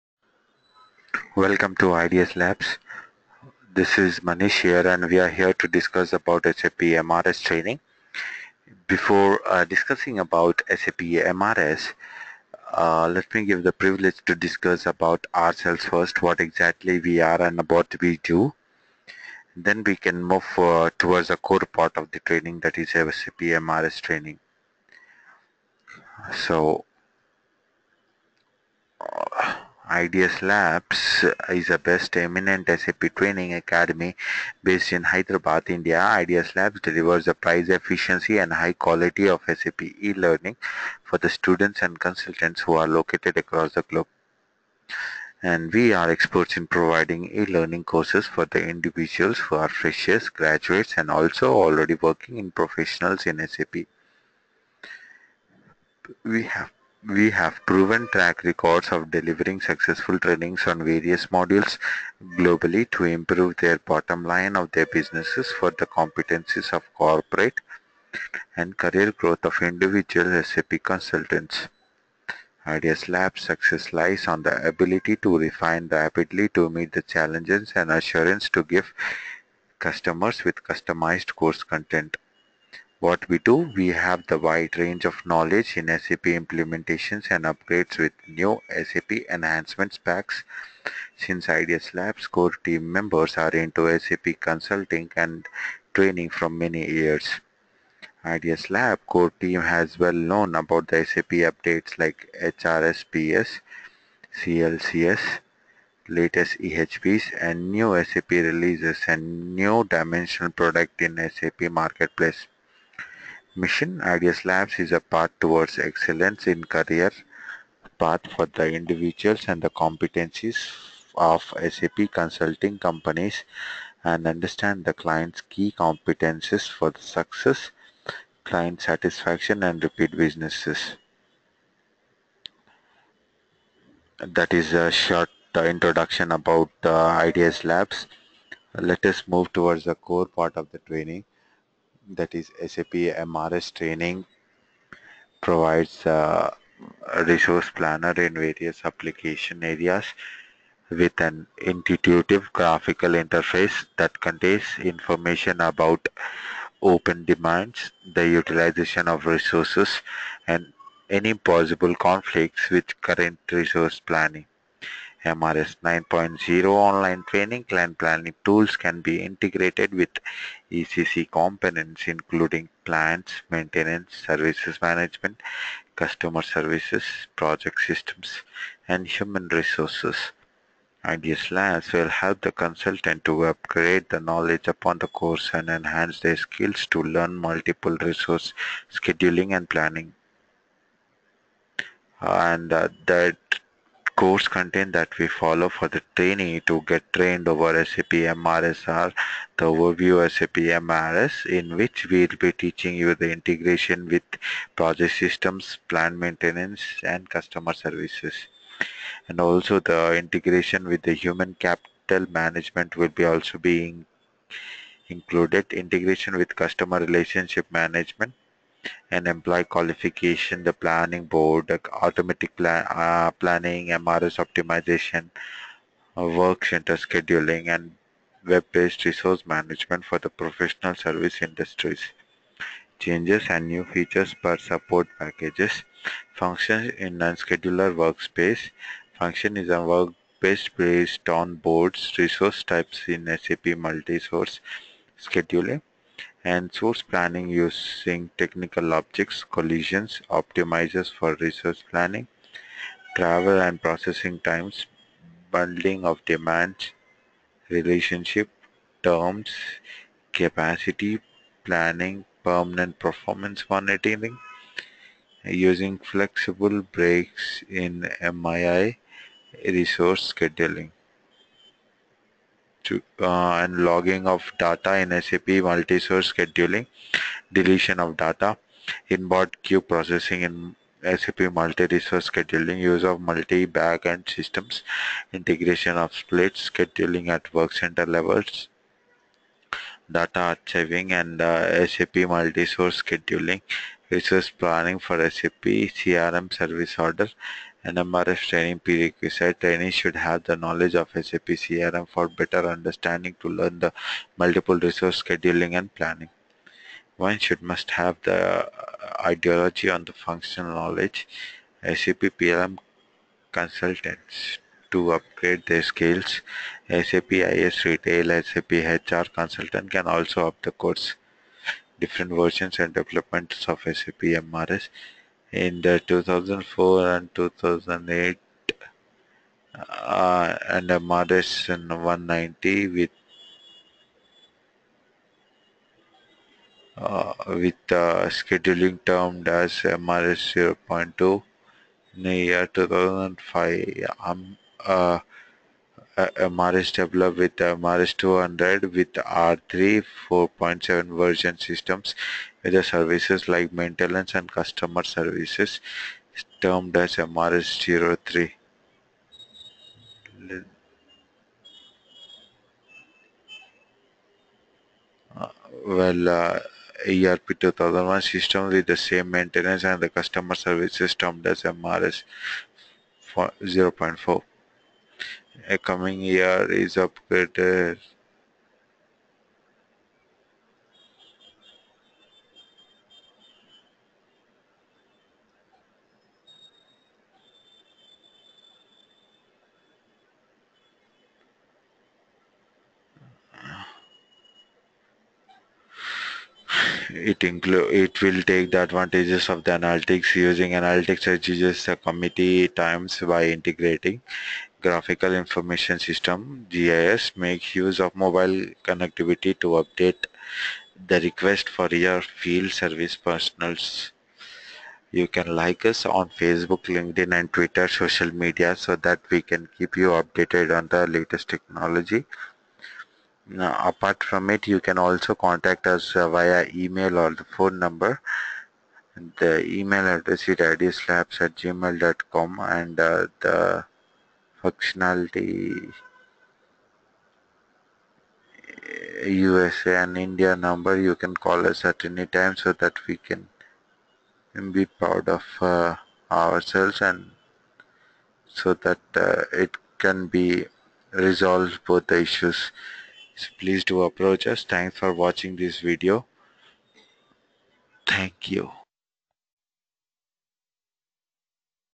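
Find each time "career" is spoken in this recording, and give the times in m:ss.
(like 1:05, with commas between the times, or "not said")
1:08, 1:56.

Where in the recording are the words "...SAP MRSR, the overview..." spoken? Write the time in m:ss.
3:17.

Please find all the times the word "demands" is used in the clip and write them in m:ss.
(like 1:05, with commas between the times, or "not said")
2:37, 4:16.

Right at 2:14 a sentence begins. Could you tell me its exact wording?
That is a short uh, introduction about the uh, IDES Labs.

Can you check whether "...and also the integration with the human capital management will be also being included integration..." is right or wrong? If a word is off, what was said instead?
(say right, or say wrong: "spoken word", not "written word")
right.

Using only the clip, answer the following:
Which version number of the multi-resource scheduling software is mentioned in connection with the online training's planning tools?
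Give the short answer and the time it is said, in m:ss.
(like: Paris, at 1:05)
MRS 9.0, at 2:45.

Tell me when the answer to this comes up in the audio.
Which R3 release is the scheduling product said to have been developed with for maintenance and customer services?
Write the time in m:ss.
5:50.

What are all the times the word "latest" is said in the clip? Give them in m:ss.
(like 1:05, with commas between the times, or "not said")
1:46, 7:01.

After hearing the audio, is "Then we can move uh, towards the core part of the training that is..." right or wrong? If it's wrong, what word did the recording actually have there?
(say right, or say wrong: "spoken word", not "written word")
right.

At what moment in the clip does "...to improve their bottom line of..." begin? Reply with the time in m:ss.
1:02.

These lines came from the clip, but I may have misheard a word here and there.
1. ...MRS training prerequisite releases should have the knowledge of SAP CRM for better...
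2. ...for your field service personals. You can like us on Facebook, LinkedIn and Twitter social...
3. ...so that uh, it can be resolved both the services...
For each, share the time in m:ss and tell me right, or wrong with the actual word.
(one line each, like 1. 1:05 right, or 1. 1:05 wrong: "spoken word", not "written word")
1. 4:57 wrong: "trainees", not "releases"
2. 6:51 right
3. 7:28 wrong: "issues", not "services".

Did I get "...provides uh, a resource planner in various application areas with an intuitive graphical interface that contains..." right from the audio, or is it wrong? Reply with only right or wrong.
right.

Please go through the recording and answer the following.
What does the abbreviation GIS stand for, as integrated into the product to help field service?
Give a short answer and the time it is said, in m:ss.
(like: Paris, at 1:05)
Graphical Information System, at 6:44.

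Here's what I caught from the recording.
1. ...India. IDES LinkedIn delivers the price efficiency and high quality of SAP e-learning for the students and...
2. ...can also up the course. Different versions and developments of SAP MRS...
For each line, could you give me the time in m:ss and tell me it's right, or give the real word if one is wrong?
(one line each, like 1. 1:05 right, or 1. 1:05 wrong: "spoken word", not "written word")
1. 0:35 wrong: "Labs", not "LinkedIn"
2. 5:19 right.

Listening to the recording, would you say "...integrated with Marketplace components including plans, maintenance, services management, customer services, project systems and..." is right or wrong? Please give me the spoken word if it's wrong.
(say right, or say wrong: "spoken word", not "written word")
wrong: "ECC", not "Marketplace".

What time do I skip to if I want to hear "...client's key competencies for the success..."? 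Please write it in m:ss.
2:04.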